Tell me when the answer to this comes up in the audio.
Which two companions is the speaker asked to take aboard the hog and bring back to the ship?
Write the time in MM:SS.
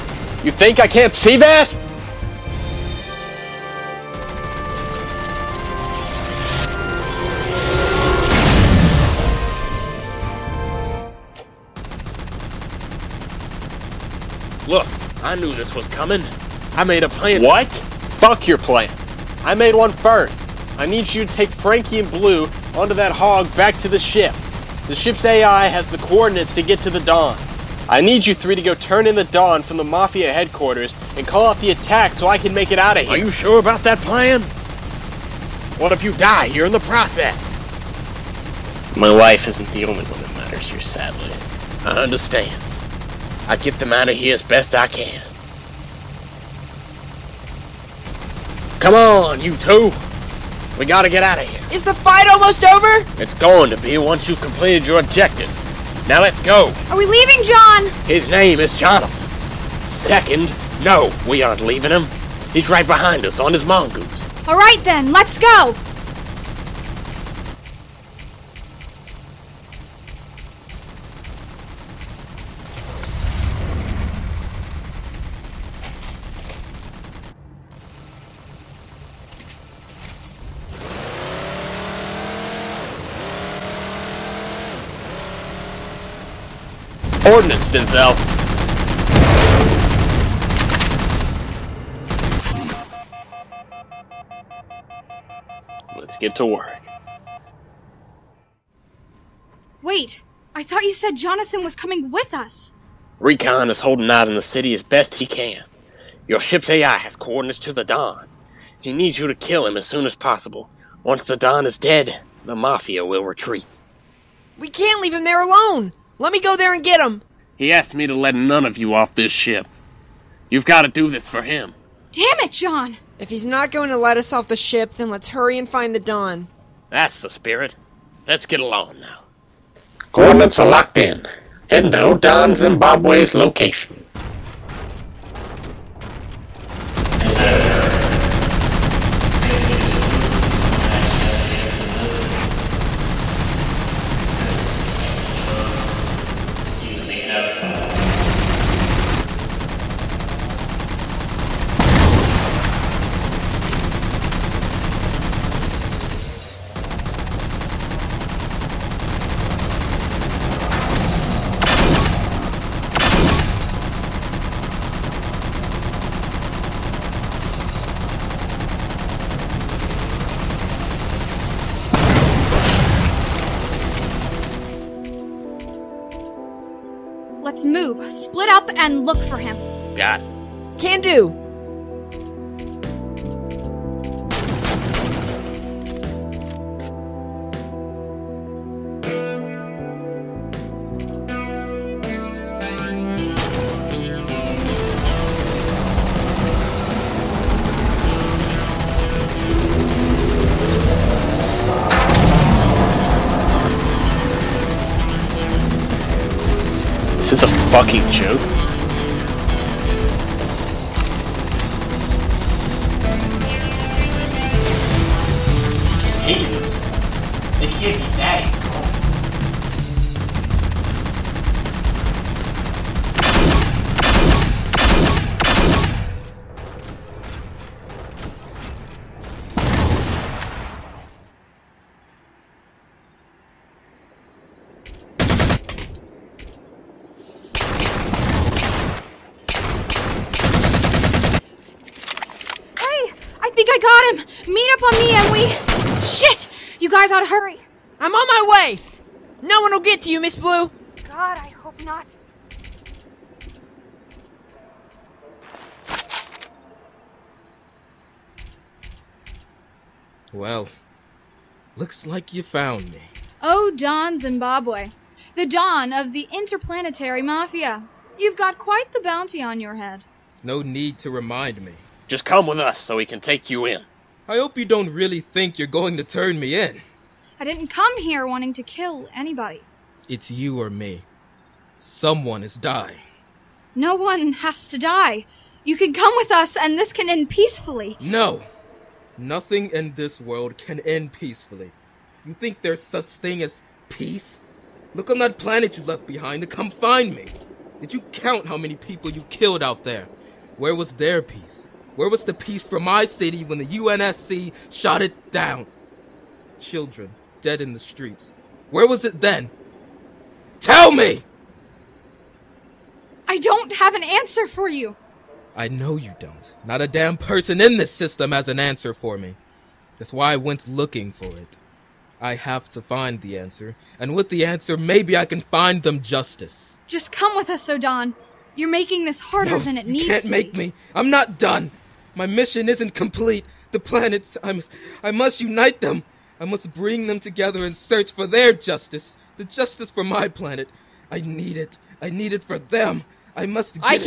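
00:21.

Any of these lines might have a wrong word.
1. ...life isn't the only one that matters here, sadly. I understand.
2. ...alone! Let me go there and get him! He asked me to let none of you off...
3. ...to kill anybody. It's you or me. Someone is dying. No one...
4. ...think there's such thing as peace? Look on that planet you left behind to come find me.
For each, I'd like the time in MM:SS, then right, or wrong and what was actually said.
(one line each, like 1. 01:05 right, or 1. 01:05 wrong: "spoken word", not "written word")
1. 00:39 right
2. 01:55 right
3. 04:38 right
4. 04:52 right.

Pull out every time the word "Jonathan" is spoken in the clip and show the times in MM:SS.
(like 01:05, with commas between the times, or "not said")
00:58, 01:41.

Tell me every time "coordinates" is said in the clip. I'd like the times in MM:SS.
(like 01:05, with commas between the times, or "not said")
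00:25, 01:27, 01:47, 02:10.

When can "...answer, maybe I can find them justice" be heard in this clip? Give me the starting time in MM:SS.
05:24.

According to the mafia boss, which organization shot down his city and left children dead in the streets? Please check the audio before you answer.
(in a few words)
UNSC.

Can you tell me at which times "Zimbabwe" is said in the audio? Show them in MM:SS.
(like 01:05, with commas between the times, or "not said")
02:12, 04:24.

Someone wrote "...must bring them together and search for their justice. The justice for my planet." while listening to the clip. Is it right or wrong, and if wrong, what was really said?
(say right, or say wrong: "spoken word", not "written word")
right.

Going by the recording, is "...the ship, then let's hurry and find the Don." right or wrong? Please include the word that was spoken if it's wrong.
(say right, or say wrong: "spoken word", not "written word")
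right.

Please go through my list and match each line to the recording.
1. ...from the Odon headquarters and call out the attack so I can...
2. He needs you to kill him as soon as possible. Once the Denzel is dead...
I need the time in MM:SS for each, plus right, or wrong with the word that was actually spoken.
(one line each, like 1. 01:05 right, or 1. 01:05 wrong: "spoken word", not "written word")
1. 00:29 wrong: "Mafia", not "Odon"
2. 01:48 wrong: "Don", not "Denzel".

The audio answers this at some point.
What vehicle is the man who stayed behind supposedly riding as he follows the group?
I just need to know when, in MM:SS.
01:03.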